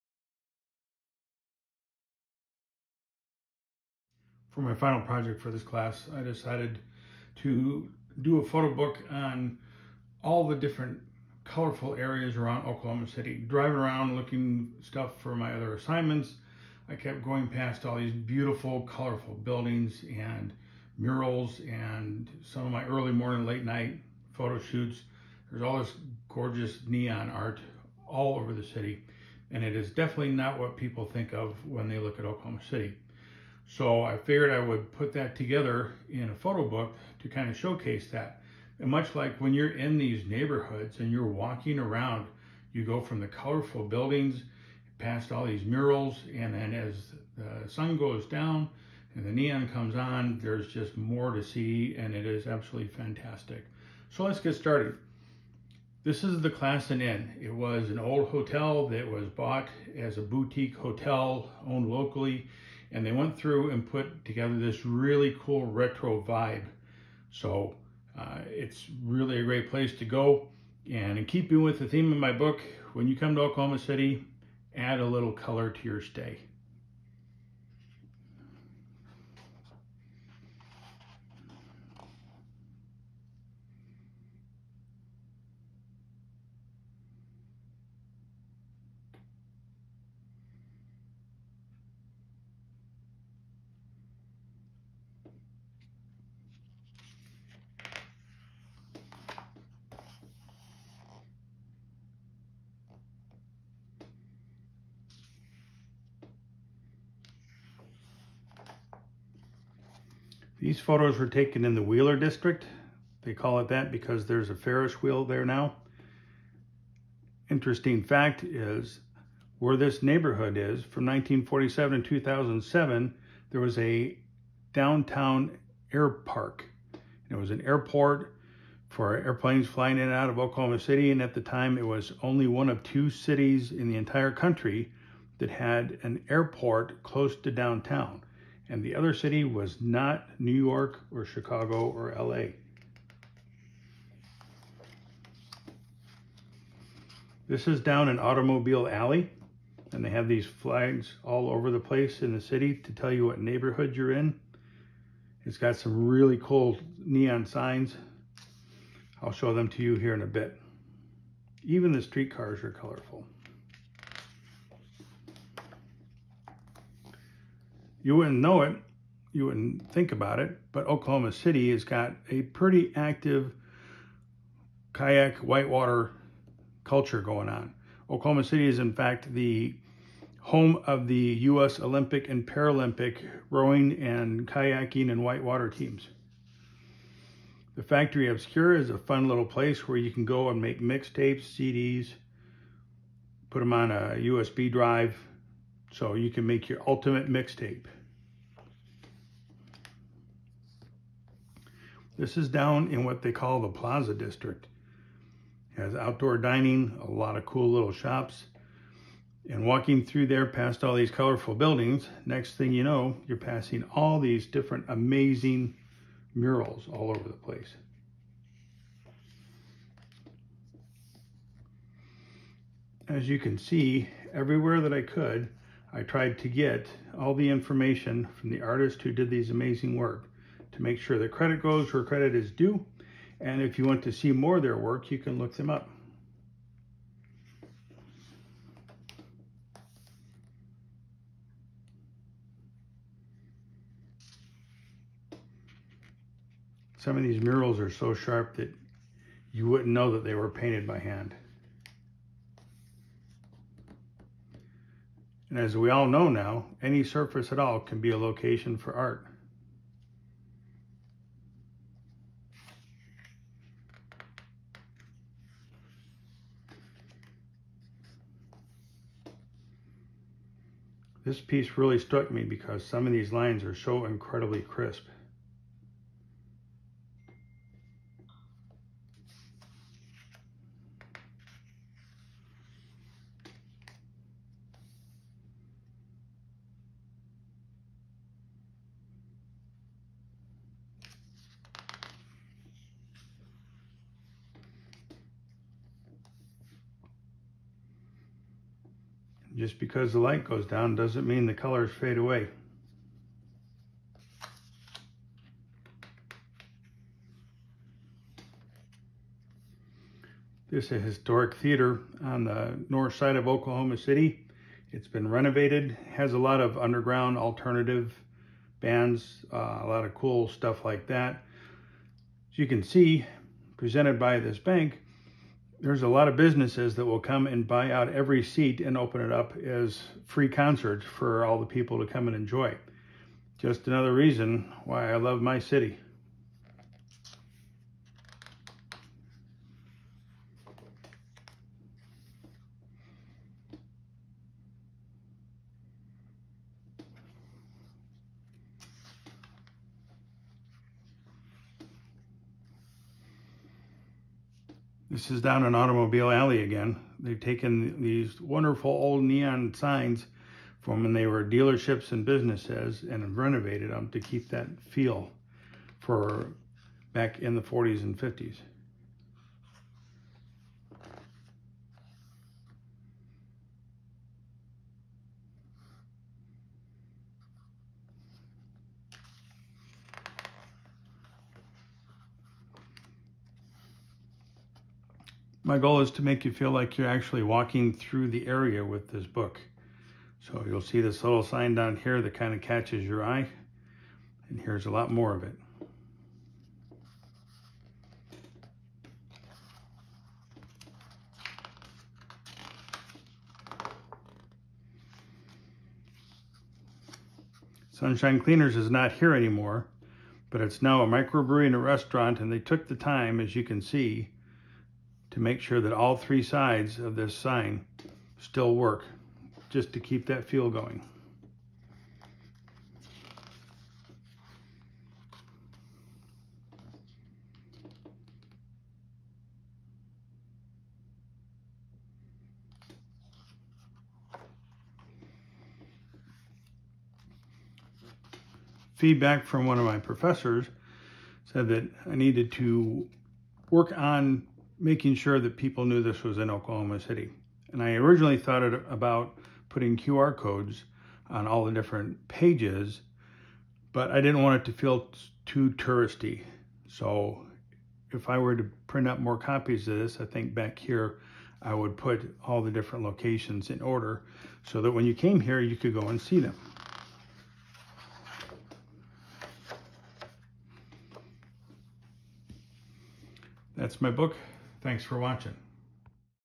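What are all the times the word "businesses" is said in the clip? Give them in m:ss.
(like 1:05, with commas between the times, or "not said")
5:26, 6:02.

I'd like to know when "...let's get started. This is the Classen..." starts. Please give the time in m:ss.
0:54.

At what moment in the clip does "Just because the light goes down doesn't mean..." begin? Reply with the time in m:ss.
4:59.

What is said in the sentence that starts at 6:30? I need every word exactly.
So you'll see this little sign down here that kind of catches your eye.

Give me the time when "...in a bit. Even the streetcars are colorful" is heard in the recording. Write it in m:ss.
2:40.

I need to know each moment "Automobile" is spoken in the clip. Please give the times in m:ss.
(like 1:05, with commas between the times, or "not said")
2:28, 5:55.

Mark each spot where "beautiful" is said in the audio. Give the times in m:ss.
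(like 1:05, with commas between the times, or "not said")
0:18.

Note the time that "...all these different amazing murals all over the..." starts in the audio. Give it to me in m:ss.
3:33.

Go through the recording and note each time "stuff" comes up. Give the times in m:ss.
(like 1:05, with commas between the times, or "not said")
0:14, 5:20.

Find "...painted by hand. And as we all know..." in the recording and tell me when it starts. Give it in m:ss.
4:10.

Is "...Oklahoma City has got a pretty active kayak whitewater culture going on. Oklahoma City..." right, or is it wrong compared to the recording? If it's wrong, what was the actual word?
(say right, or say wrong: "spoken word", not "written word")
right.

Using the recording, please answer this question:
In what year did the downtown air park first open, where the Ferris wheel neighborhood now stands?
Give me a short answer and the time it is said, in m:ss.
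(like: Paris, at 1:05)
1947, at 2:01.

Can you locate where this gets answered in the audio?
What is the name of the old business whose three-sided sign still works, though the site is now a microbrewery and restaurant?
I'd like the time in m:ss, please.
6:47.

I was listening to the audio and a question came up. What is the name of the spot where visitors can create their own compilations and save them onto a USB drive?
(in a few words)
Factory Obscura.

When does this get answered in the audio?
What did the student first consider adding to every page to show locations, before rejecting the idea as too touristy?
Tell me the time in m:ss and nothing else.
7:29.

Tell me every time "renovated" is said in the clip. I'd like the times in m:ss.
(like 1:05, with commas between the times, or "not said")
5:15, 6:03.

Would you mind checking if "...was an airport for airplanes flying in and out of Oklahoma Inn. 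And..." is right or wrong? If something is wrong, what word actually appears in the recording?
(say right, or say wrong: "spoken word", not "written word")
wrong: "City", not "Inn".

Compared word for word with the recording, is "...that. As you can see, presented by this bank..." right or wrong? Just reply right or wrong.
right.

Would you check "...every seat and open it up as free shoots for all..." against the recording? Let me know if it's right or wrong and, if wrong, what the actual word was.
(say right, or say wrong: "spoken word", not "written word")
wrong: "concerts", not "shoots".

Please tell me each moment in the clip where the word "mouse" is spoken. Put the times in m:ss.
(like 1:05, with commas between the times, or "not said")
not said.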